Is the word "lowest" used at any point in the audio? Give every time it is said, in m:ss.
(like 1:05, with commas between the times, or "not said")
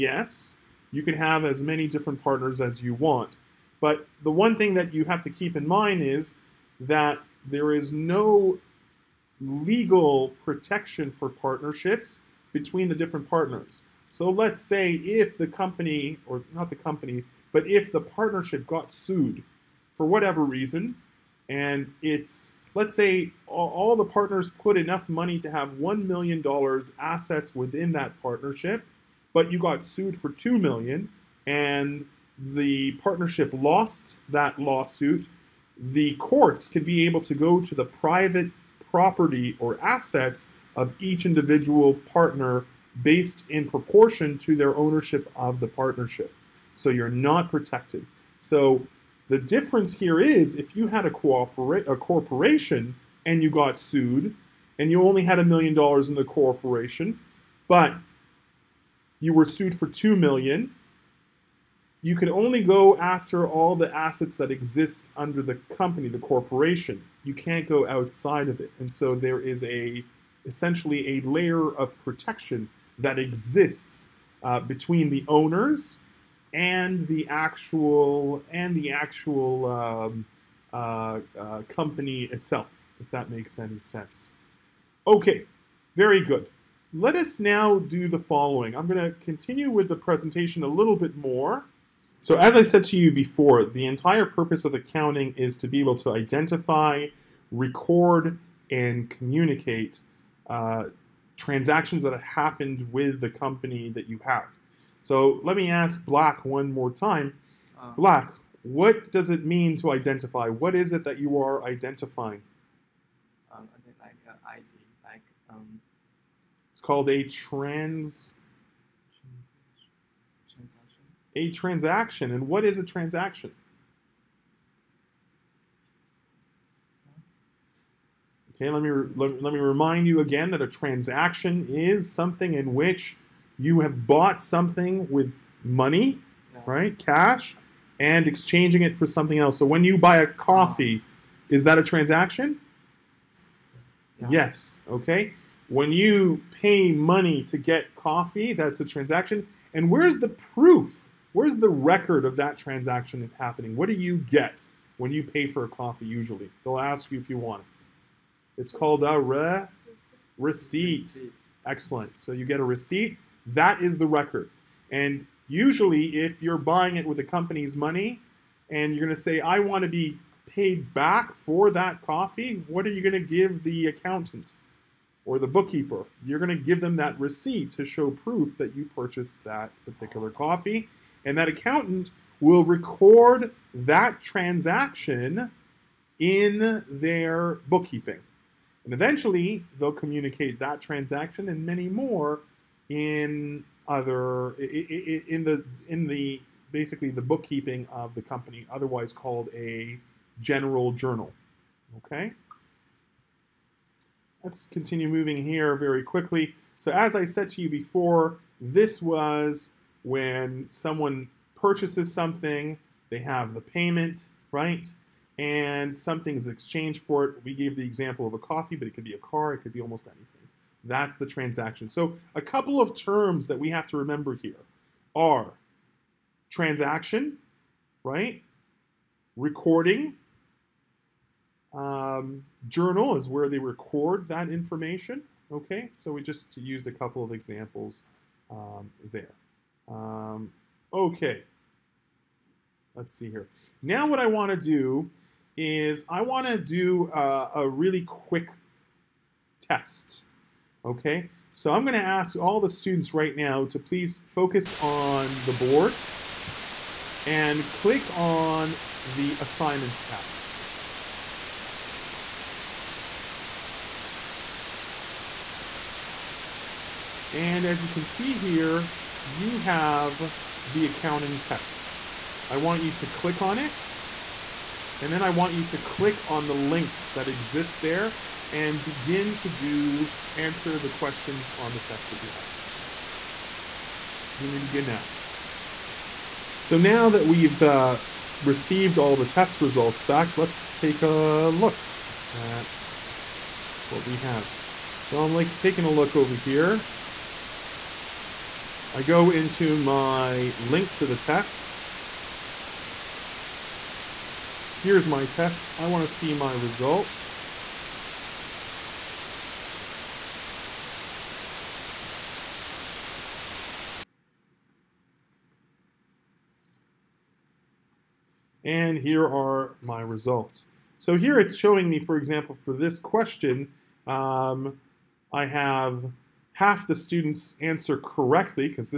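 not said.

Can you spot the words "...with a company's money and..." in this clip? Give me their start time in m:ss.
2:47.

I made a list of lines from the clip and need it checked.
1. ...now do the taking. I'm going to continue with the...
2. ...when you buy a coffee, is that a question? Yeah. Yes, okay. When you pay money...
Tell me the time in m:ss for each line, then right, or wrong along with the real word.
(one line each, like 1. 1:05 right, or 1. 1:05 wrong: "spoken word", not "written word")
1. 1:27 wrong: "following", not "taking"
2. 2:19 wrong: "transaction", not "question".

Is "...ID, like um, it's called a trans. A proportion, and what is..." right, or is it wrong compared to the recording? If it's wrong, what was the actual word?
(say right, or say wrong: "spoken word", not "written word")
wrong: "transaction", not "proportion".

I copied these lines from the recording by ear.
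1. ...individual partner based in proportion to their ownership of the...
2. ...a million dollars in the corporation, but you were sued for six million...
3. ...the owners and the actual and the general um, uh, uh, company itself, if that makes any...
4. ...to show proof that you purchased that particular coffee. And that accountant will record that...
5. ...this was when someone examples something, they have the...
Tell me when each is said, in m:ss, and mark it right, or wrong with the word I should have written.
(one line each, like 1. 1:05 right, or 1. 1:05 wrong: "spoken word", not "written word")
1. 0:41 right
2. 0:55 wrong: "two", not "six"
3. 1:15 wrong: "actual", not "general"
4. 2:57 right
5. 3:28 wrong: "purchases", not "examples".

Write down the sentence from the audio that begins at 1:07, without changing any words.
You can't go outside of it.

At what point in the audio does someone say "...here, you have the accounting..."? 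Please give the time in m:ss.
4:28.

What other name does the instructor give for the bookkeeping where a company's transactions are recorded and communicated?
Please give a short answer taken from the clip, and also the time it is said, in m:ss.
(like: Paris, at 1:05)
general journal, at 3:20.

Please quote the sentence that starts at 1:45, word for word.
So let me ask Black one more time.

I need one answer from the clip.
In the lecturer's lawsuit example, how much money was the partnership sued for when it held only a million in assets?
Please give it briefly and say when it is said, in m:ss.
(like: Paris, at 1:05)
$2 million, at 0:30.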